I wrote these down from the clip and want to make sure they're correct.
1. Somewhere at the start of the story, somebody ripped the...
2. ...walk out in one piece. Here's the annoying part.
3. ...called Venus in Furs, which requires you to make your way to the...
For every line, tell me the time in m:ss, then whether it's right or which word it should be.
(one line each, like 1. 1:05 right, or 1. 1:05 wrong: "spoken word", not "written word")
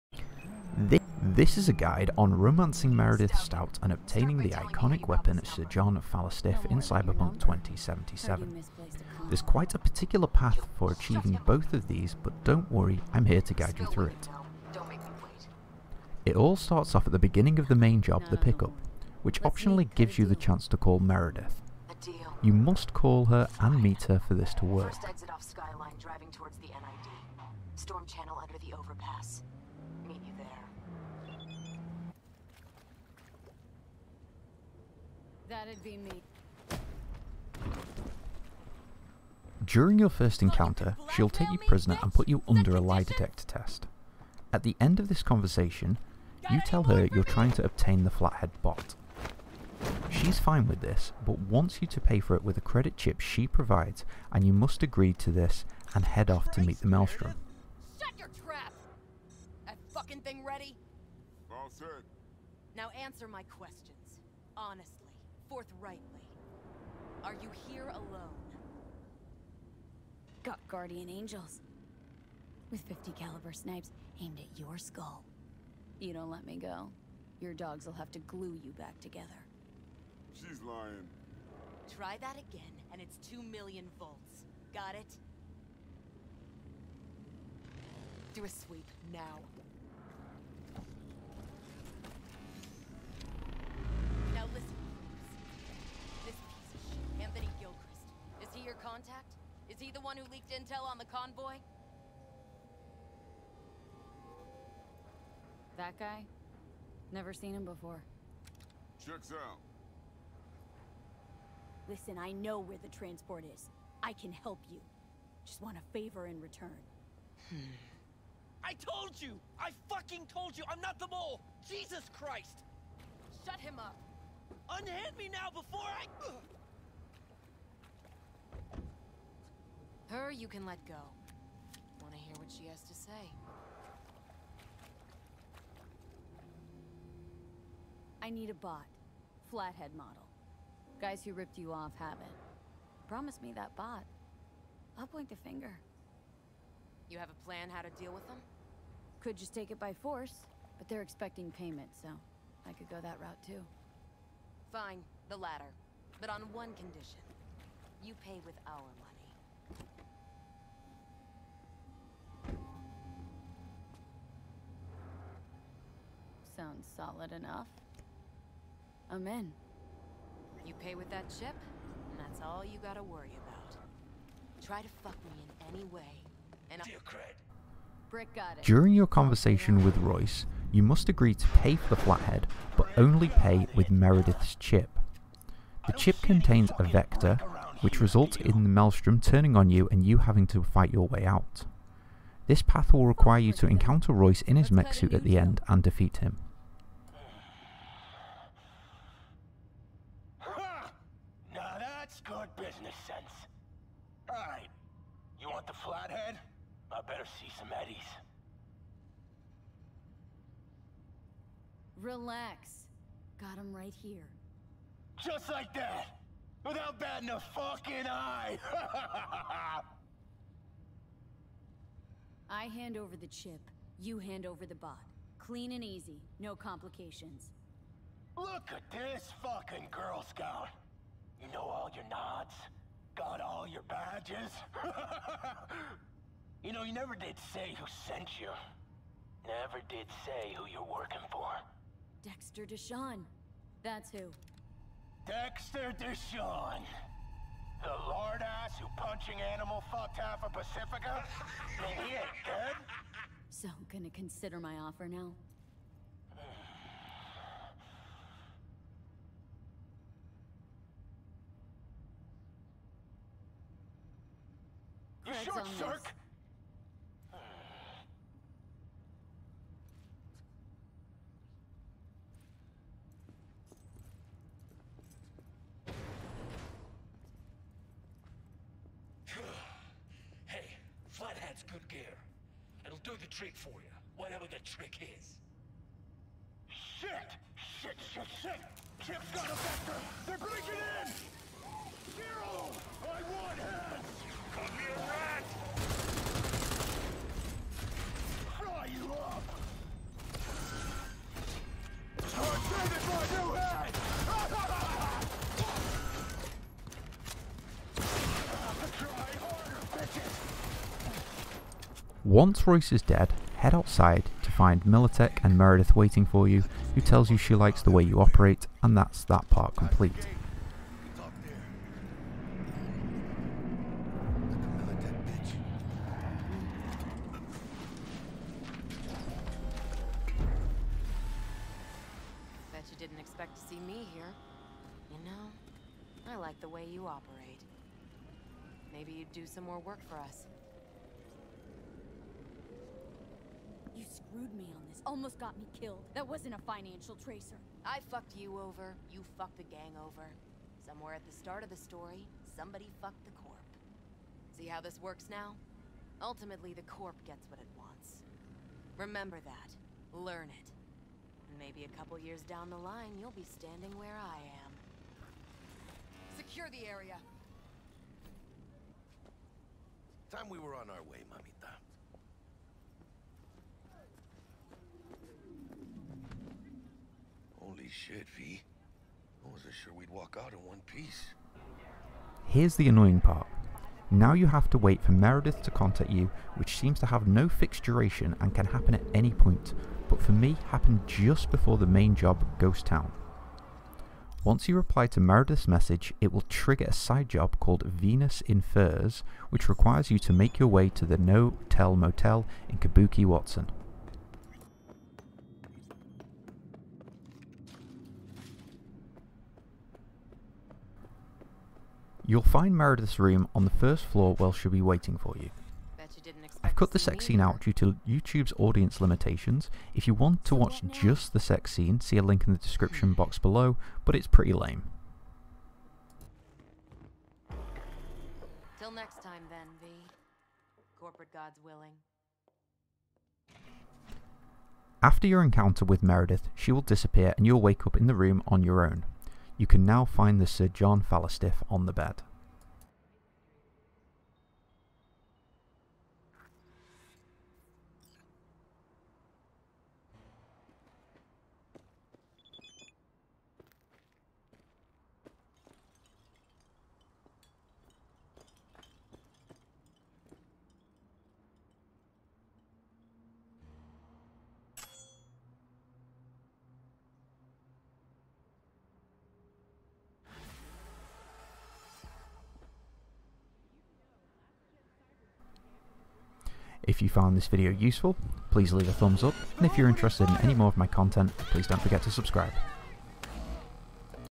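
1. 5:50 wrong: "fucked", not "ripped"
2. 6:20 right
3. 6:37 right.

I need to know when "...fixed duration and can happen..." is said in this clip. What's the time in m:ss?
6:27.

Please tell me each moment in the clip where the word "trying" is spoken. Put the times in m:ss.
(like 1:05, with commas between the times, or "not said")
0:47.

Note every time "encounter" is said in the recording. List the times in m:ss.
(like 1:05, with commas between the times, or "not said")
0:40, 3:13, 7:15.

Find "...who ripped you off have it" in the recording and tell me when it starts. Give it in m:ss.
2:21.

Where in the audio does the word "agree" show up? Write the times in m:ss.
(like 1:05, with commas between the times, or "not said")
0:54, 3:01.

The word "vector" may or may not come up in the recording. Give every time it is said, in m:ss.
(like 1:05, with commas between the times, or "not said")
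3:06, 4:49.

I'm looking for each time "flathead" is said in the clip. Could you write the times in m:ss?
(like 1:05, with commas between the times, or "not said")
0:48, 2:19, 3:01.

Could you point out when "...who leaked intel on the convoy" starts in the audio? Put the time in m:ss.
1:40.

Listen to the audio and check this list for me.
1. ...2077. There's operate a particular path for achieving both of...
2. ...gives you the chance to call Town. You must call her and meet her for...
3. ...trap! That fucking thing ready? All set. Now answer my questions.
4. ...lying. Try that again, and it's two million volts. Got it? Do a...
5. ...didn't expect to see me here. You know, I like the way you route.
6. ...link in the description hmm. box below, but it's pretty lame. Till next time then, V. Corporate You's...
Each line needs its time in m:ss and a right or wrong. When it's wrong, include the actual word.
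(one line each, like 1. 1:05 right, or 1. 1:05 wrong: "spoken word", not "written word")
1. 0:07 wrong: "quite", not "operate"
2. 0:19 wrong: "Meredith", not "Town"
3. 0:58 right
4. 1:20 right
5. 5:32 wrong: "operate", not "route"
6. 7:02 wrong: "God", not "You".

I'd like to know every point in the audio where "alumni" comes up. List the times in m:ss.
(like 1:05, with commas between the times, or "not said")
not said.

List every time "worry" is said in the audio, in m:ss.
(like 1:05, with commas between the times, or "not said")
0:12, 2:53.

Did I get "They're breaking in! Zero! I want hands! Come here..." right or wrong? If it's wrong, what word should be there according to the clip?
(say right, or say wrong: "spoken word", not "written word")
right.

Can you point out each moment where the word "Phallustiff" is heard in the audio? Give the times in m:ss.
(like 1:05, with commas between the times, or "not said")
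0:06, 7:21.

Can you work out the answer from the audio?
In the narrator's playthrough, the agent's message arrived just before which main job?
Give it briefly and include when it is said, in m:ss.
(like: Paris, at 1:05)
Ghost Town, at 6:32.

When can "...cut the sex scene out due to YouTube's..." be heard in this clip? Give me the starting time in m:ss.
6:56.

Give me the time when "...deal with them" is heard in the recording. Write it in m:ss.
2:27.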